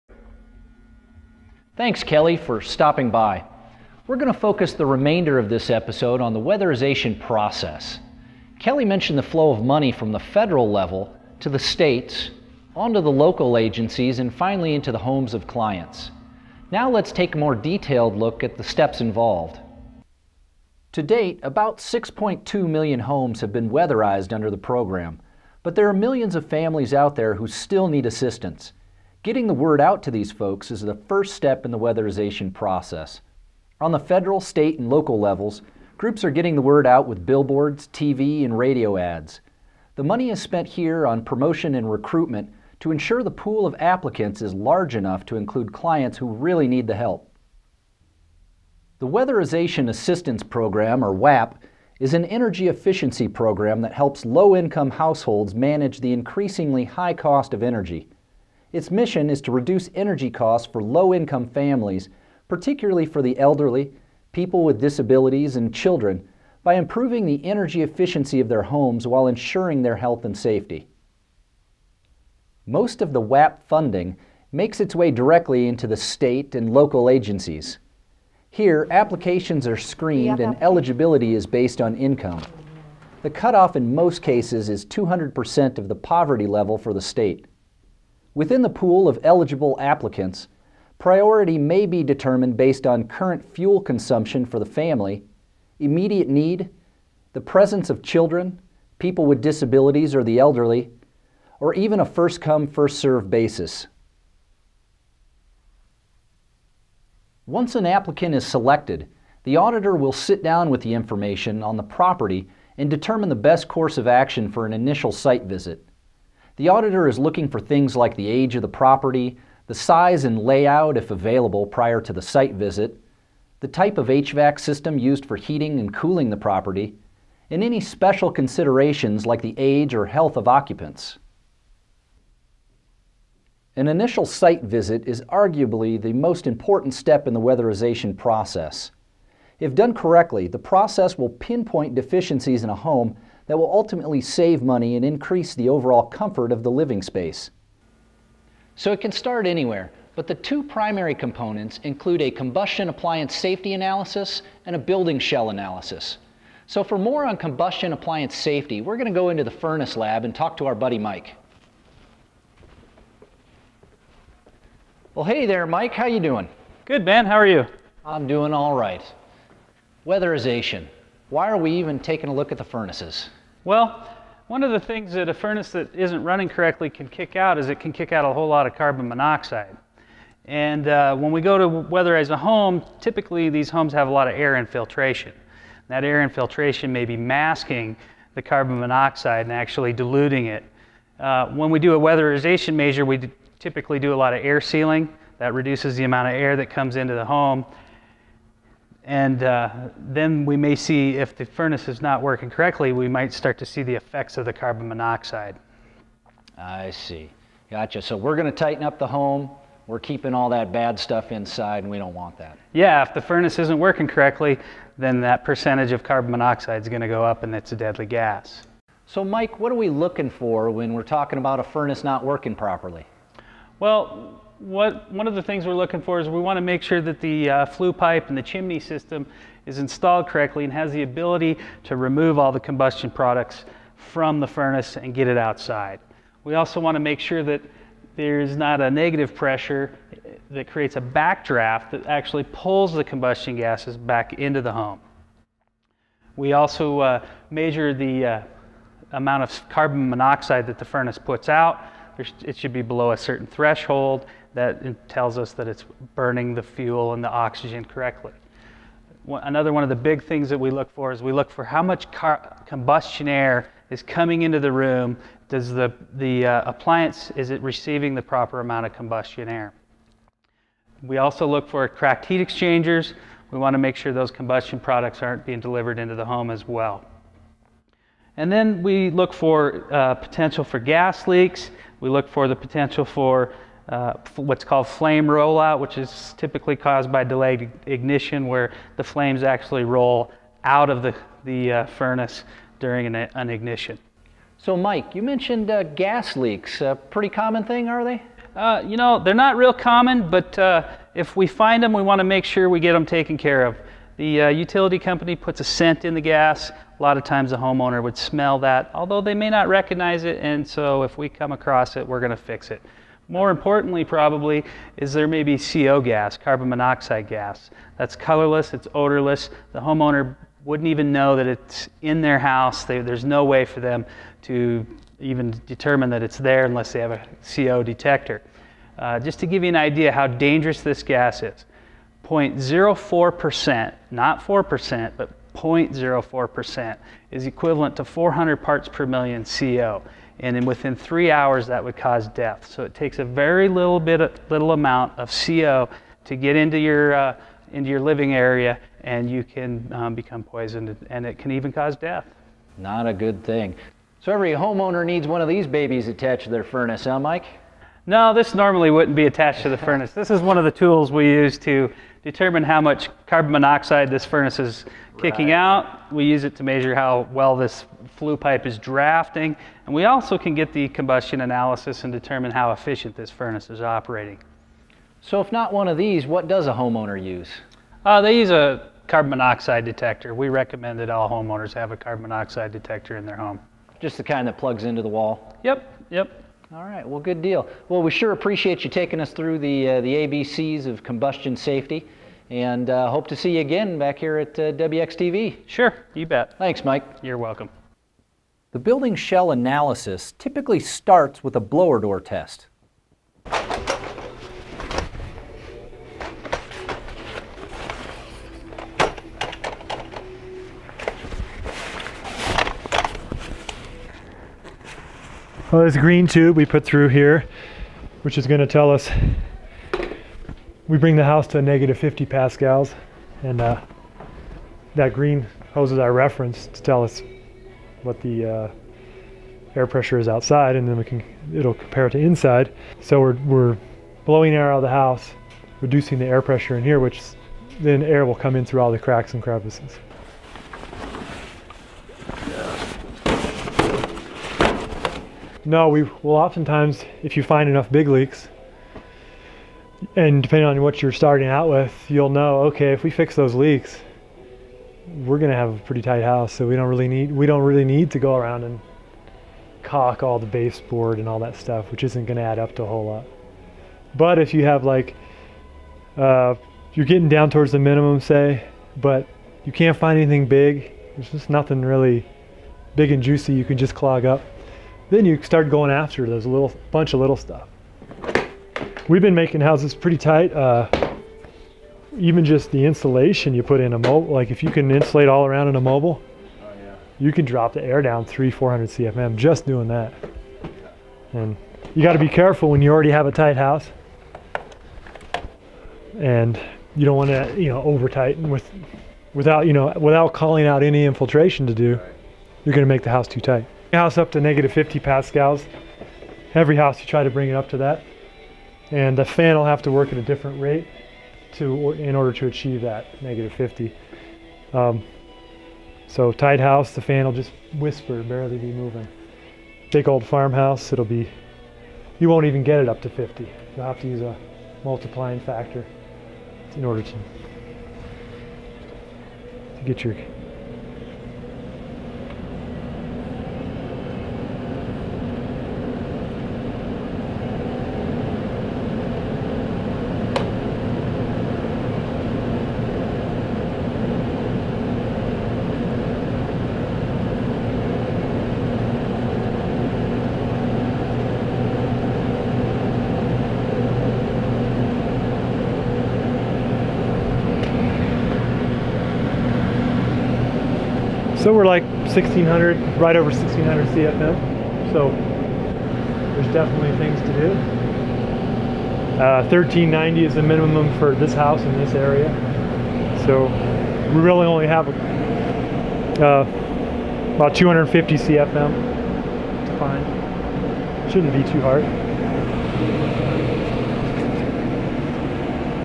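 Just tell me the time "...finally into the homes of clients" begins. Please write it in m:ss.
0:14.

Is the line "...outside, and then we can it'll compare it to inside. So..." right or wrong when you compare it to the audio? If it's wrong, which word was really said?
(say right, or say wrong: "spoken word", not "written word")
right.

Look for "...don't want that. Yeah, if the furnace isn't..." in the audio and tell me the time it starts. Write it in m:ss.
3:31.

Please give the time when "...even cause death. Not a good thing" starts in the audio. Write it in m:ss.
5:51.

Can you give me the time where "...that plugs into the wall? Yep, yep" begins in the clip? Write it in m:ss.
6:24.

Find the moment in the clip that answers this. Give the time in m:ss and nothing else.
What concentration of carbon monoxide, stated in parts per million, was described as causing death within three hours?
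5:38.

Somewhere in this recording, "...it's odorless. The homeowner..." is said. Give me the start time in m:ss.
5:18.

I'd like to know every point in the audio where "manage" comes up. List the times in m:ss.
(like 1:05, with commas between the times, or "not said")
0:55.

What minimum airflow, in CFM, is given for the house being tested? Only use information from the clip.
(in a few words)
1390.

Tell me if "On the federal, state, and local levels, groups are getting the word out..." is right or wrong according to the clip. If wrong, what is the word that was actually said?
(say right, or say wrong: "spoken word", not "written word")
right.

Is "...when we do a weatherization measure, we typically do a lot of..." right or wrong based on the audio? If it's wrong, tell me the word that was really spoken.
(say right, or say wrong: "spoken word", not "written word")
right.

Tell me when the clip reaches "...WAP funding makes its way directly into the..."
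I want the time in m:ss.
1:13.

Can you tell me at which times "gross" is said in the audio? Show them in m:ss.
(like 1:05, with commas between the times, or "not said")
not said.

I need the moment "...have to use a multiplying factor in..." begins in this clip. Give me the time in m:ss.
8:43.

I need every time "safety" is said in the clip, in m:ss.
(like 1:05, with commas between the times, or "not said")
1:10, 2:33, 2:38, 6:31.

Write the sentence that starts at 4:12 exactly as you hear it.
There's, it should be below a certain threshold that tells us that it's burning the fuel and the oxygen correctly.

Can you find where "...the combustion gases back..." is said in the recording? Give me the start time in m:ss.
4:02.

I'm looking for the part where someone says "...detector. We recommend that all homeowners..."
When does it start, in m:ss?
6:19.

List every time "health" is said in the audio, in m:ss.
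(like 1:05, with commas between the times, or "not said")
1:09, 2:10.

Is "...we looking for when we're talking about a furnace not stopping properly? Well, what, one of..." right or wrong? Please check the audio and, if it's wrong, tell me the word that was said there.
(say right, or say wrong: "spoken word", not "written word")
wrong: "working", not "stopping".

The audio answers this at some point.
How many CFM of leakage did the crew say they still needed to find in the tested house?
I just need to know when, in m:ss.
9:37.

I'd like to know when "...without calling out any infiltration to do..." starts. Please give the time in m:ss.
8:19.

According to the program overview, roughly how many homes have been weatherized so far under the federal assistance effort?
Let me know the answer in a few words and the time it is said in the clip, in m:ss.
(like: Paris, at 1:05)
6.2 million, at 0:21.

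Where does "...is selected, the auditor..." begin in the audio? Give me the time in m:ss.
1:48.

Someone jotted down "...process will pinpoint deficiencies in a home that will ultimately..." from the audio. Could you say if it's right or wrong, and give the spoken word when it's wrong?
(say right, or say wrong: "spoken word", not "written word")
right.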